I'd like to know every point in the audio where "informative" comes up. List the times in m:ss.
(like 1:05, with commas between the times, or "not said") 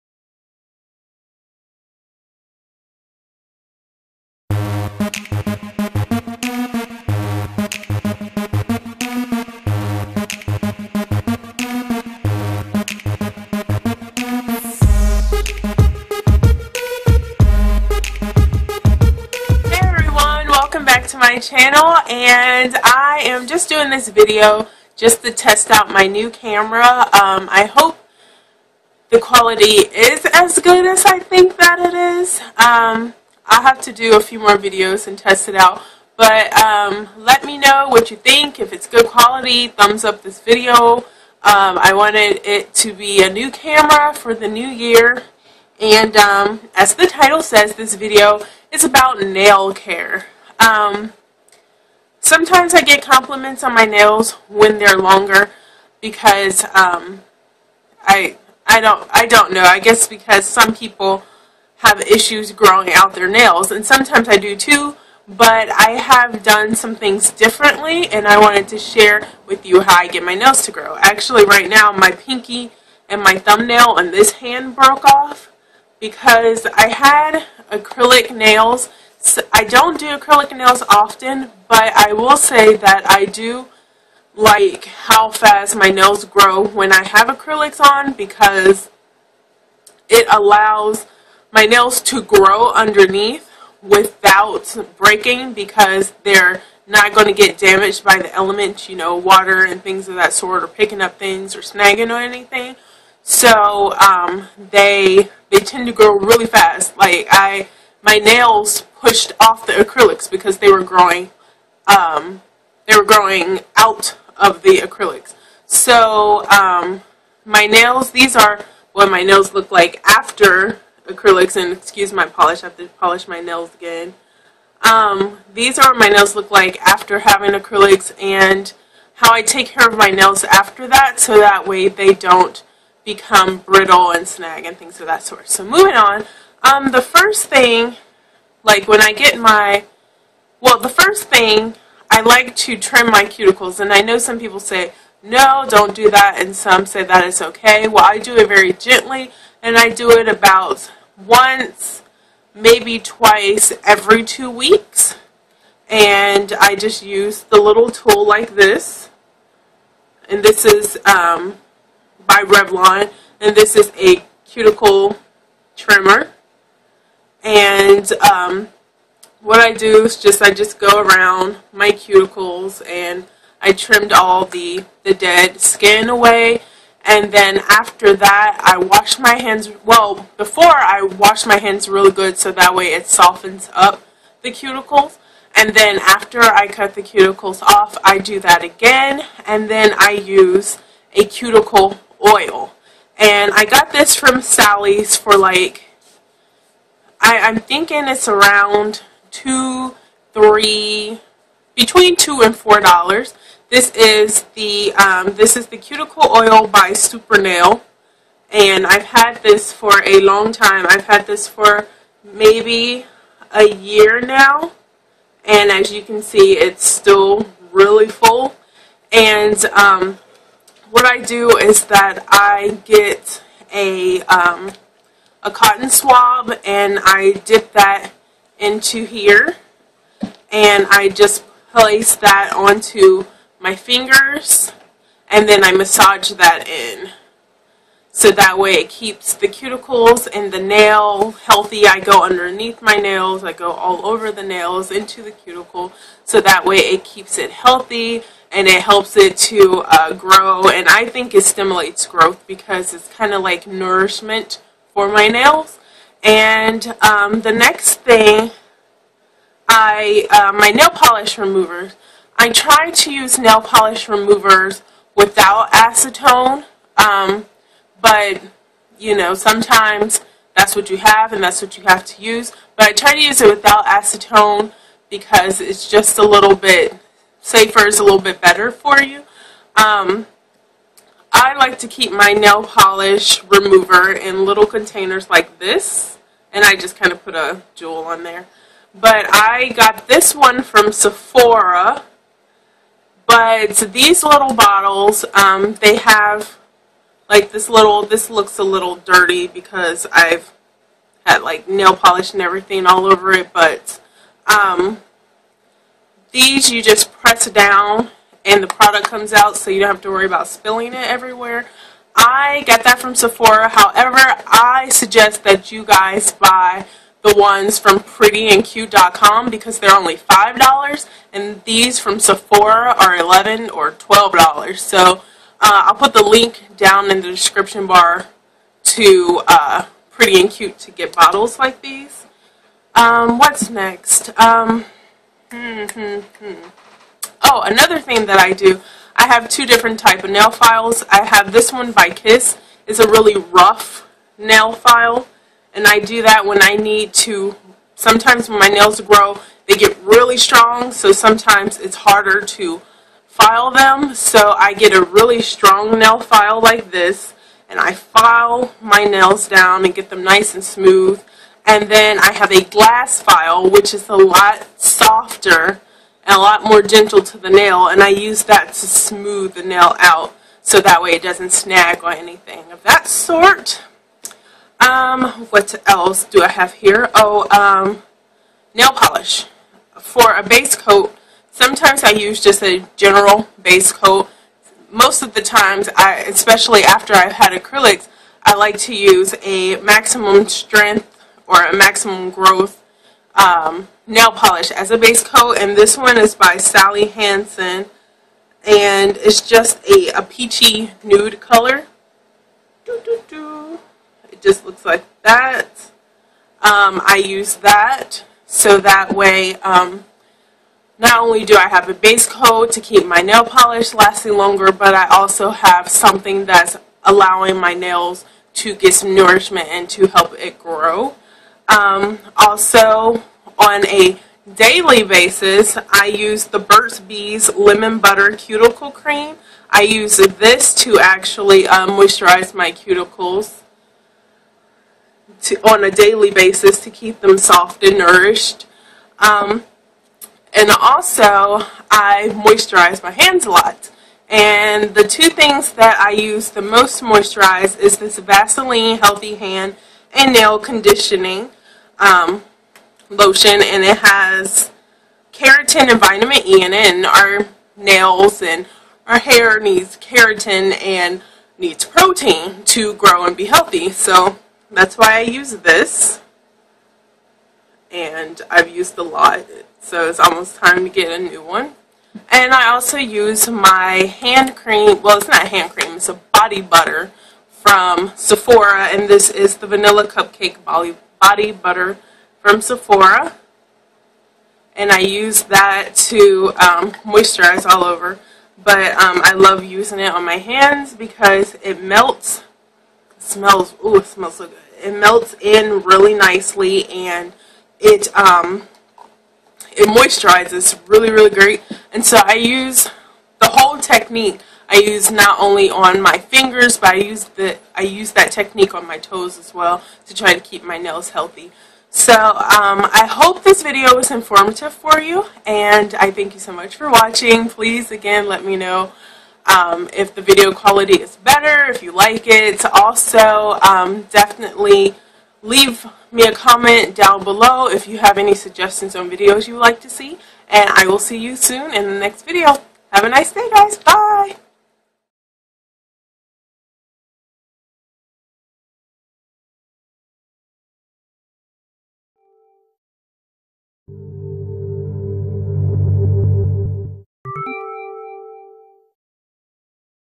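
8:34.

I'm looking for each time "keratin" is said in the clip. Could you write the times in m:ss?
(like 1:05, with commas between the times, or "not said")
7:35, 7:39.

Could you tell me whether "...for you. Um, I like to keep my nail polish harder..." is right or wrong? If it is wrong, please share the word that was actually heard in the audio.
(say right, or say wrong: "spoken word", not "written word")
wrong: "remover", not "harder".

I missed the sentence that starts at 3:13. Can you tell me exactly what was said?
And I got this from Sally's for like I, I'm thinking it's around two, three, between two and four dollars.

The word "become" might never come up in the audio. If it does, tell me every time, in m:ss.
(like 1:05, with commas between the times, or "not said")
2:13.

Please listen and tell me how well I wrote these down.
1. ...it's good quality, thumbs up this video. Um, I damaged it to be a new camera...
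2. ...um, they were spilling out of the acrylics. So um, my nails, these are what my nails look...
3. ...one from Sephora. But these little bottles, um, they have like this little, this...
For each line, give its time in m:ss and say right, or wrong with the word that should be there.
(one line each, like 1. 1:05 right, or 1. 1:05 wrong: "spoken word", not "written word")
1. 0:38 wrong: "wanted", not "damaged"
2. 1:51 wrong: "growing", not "spilling"
3. 4:50 right.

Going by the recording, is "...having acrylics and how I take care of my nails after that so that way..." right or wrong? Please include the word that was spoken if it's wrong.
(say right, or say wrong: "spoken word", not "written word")
right.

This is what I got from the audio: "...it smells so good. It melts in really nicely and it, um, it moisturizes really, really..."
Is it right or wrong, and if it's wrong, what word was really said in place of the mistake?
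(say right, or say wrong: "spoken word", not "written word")
right.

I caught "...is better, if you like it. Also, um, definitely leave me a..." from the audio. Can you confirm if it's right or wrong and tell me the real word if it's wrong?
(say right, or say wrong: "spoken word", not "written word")
right.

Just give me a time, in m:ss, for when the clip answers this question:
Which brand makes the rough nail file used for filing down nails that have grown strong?
5:42.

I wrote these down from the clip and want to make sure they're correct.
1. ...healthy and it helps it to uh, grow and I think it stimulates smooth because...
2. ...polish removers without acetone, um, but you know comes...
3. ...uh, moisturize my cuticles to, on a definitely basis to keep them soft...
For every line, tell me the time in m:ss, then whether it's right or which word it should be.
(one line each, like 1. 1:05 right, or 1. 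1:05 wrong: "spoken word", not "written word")
1. 4:07 wrong: "growth", not "smooth"
2. 4:23 wrong: "sometimes", not "comes"
3. 7:11 wrong: "daily", not "definitely".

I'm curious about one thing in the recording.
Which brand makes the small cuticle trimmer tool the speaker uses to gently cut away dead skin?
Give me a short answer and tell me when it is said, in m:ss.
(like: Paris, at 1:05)
Revlon, at 2:42.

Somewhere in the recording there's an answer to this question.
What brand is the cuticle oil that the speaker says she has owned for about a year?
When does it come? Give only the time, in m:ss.
3:26.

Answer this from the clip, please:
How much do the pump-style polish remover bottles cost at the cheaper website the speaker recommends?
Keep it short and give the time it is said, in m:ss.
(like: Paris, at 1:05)
$5, at 5:20.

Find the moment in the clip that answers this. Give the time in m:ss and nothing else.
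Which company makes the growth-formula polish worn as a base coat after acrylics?
6:36.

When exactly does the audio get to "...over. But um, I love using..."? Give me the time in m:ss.
8:07.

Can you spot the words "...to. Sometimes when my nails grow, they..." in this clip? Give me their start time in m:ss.
5:47.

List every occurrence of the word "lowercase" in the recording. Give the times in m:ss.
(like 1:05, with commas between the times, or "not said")
not said.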